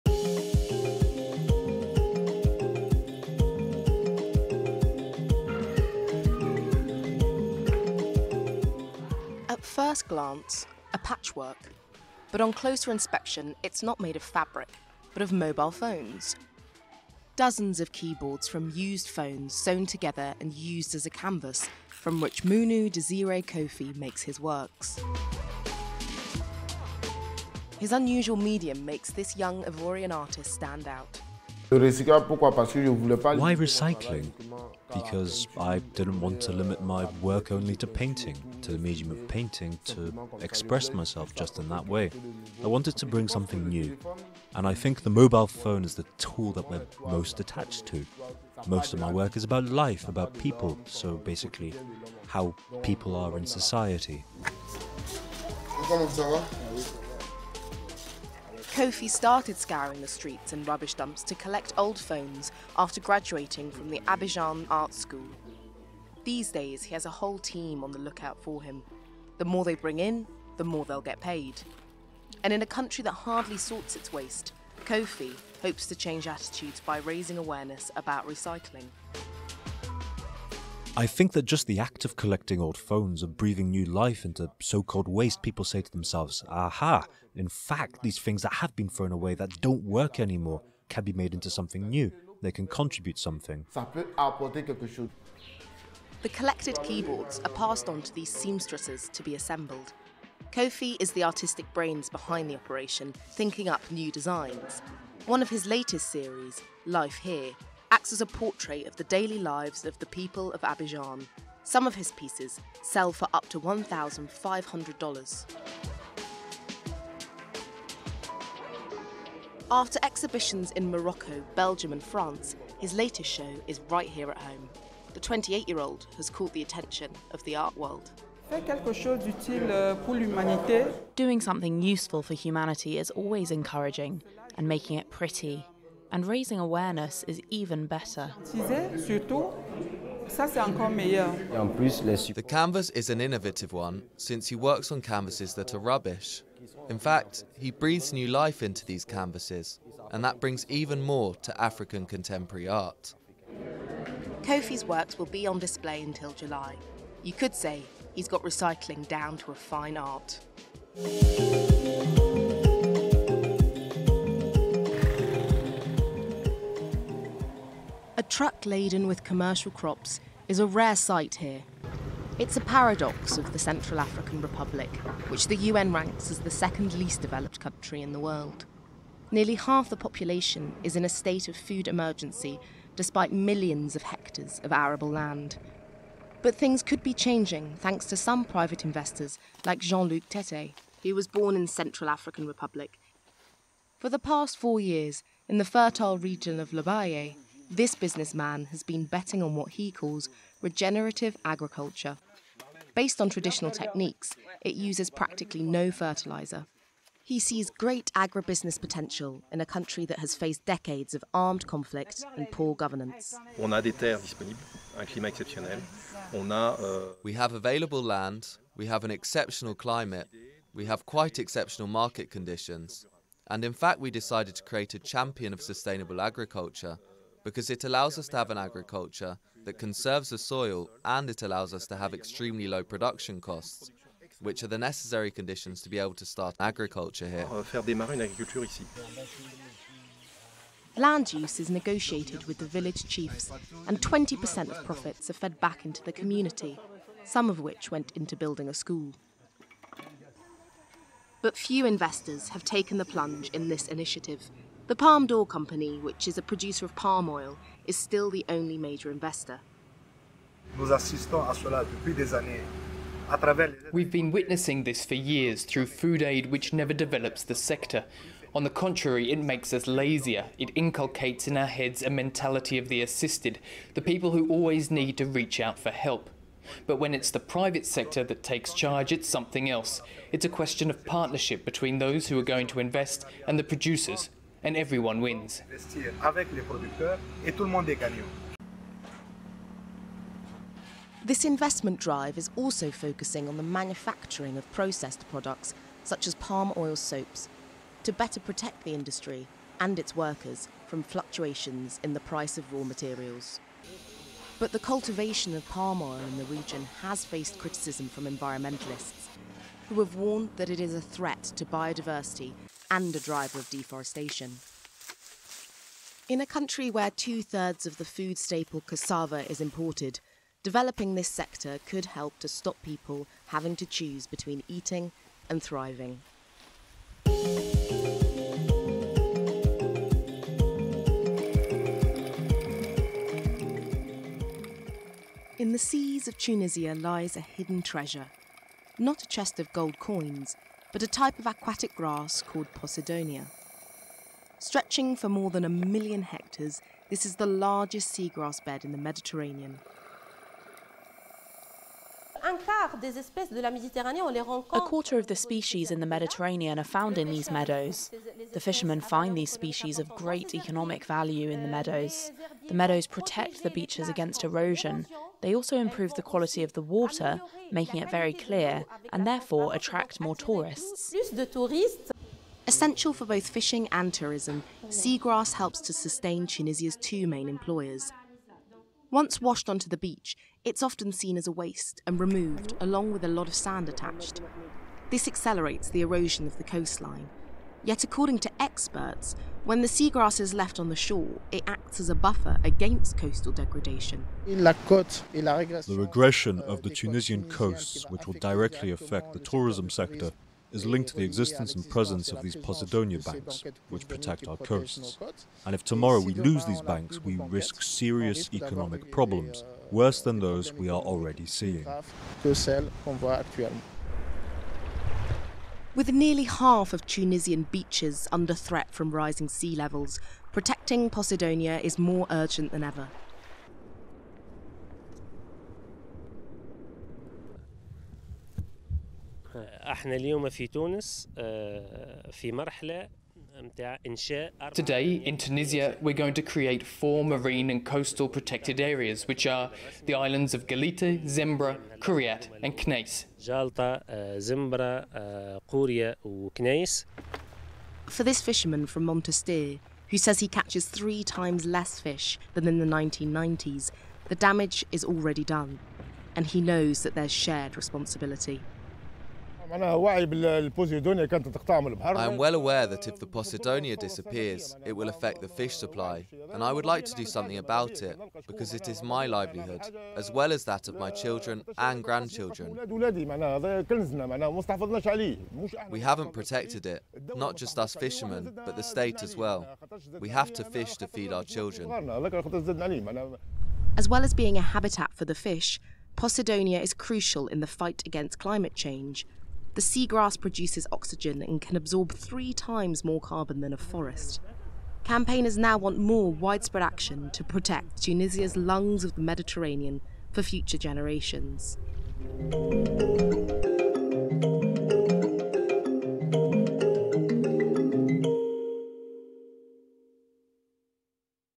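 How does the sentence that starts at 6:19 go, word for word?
Once washed onto the beach, it's often seen as a waste and removed, along with a lot of sand attached.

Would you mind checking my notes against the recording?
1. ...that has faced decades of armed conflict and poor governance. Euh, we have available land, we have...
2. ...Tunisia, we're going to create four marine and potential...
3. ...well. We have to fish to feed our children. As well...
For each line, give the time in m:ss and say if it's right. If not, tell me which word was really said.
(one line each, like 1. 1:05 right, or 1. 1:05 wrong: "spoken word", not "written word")
1. 3:30 right
2. 7:15 wrong: "coastal", not "potential"
3. 7:59 right.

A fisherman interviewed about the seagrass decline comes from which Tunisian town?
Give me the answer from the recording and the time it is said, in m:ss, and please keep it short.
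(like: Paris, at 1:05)
Monastir, at 7:29.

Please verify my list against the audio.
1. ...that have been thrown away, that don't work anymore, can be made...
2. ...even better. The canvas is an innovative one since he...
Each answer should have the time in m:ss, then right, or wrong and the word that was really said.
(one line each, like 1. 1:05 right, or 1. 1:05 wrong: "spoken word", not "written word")
1. 1:28 right
2. 2:17 right.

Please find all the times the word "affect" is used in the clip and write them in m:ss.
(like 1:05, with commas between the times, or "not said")
6:38, 7:45.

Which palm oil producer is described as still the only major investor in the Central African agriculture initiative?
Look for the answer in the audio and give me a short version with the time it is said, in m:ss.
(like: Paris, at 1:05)
Palme d'Or Company, at 4:14.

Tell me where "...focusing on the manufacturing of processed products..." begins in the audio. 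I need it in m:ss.
4:52.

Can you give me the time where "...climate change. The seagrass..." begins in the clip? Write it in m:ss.
8:08.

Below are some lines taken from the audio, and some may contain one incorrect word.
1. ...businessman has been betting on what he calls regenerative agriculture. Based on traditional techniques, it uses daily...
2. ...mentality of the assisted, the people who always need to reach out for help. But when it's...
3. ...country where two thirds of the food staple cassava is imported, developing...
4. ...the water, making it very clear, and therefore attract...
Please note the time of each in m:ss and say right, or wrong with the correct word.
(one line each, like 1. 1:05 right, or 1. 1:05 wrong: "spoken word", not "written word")
1. 3:17 wrong: "practically", not "daily"
2. 4:32 right
3. 5:16 right
4. 6:06 right.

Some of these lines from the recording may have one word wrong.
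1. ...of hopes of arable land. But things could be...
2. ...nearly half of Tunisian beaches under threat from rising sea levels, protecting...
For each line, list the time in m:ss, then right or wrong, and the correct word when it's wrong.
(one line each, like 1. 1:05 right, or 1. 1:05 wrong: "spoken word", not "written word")
1. 3:03 wrong: "hectares", not "hopes"
2. 6:56 right.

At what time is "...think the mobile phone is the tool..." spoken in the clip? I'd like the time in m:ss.
0:44.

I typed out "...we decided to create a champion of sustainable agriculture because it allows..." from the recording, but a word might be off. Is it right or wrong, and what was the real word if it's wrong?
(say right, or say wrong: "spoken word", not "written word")
right.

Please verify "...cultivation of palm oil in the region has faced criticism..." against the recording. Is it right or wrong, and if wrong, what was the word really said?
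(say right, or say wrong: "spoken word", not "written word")
right.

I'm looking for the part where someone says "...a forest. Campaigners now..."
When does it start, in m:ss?
8:13.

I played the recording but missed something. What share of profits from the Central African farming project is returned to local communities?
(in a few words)
20%.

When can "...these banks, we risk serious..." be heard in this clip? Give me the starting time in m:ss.
6:46.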